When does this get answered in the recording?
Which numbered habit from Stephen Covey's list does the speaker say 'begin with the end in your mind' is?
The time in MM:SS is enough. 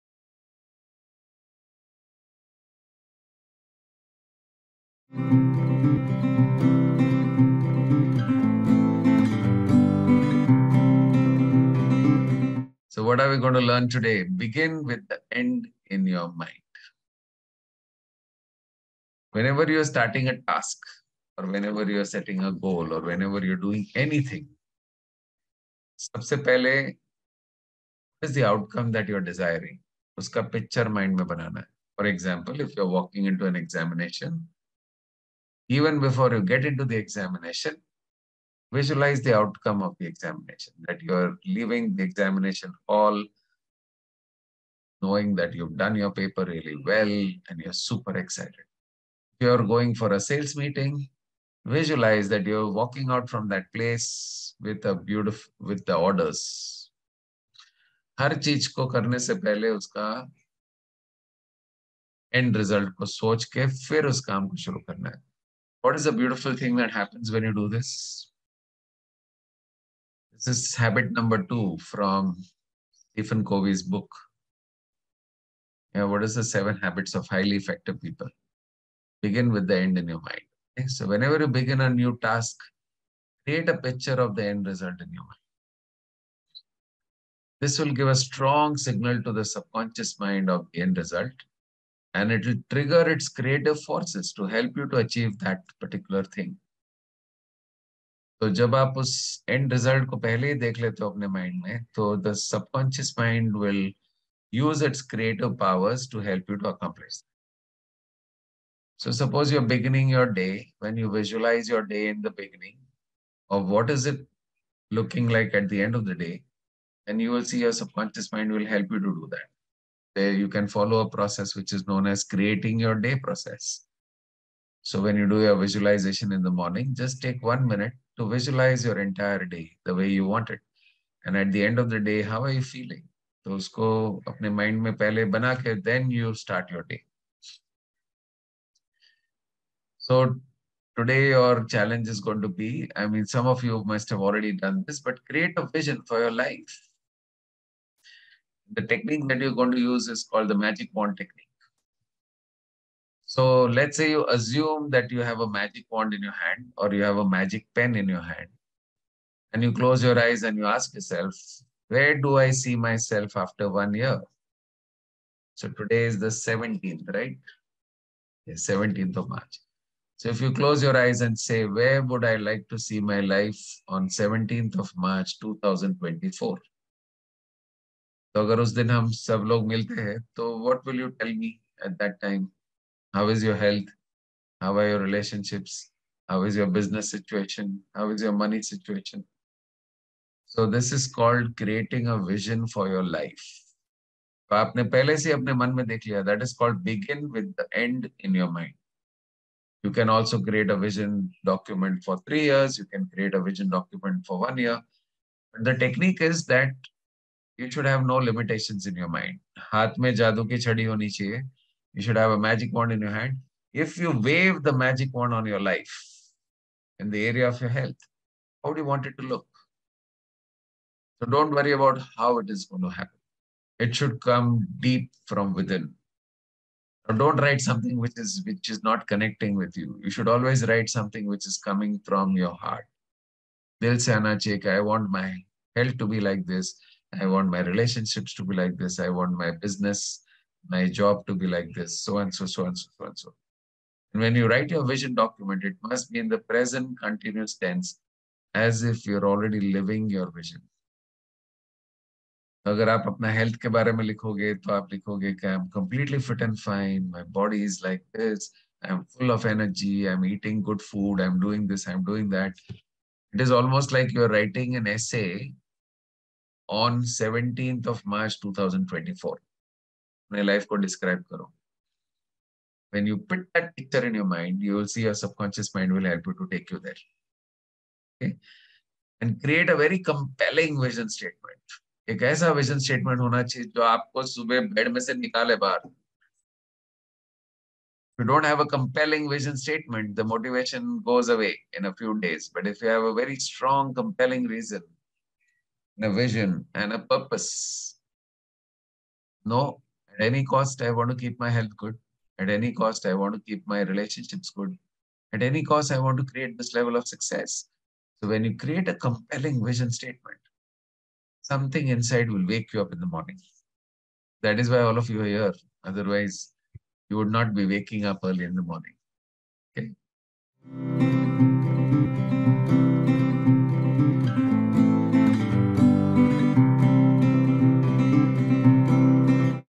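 01:10.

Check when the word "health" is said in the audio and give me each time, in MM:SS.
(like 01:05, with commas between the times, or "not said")
03:37, 03:55, 05:01.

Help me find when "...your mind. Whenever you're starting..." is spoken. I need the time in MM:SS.
00:16.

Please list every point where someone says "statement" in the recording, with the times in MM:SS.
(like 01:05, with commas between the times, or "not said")
04:41, 04:49, 05:09.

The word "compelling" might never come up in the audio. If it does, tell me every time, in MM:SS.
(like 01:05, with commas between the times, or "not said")
04:40, 04:48, 04:54, 05:08.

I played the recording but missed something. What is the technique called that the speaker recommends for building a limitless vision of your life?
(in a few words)
Magic wand technique.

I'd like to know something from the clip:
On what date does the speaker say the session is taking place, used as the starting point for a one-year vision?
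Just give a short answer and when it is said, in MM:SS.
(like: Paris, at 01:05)
17th of March, at 02:48.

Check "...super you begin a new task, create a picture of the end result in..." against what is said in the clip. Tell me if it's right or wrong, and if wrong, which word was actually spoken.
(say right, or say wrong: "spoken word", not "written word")
wrong: "whenever", not "super".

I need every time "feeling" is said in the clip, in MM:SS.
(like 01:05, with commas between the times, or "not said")
02:12.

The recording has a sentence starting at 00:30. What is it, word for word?
उसका picture mind में बनाना है.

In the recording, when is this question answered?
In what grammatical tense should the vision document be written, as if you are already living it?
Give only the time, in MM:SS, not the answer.
04:06.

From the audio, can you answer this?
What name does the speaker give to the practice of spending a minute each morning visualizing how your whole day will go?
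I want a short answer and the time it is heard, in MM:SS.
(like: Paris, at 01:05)
Creating your day process, at 02:02.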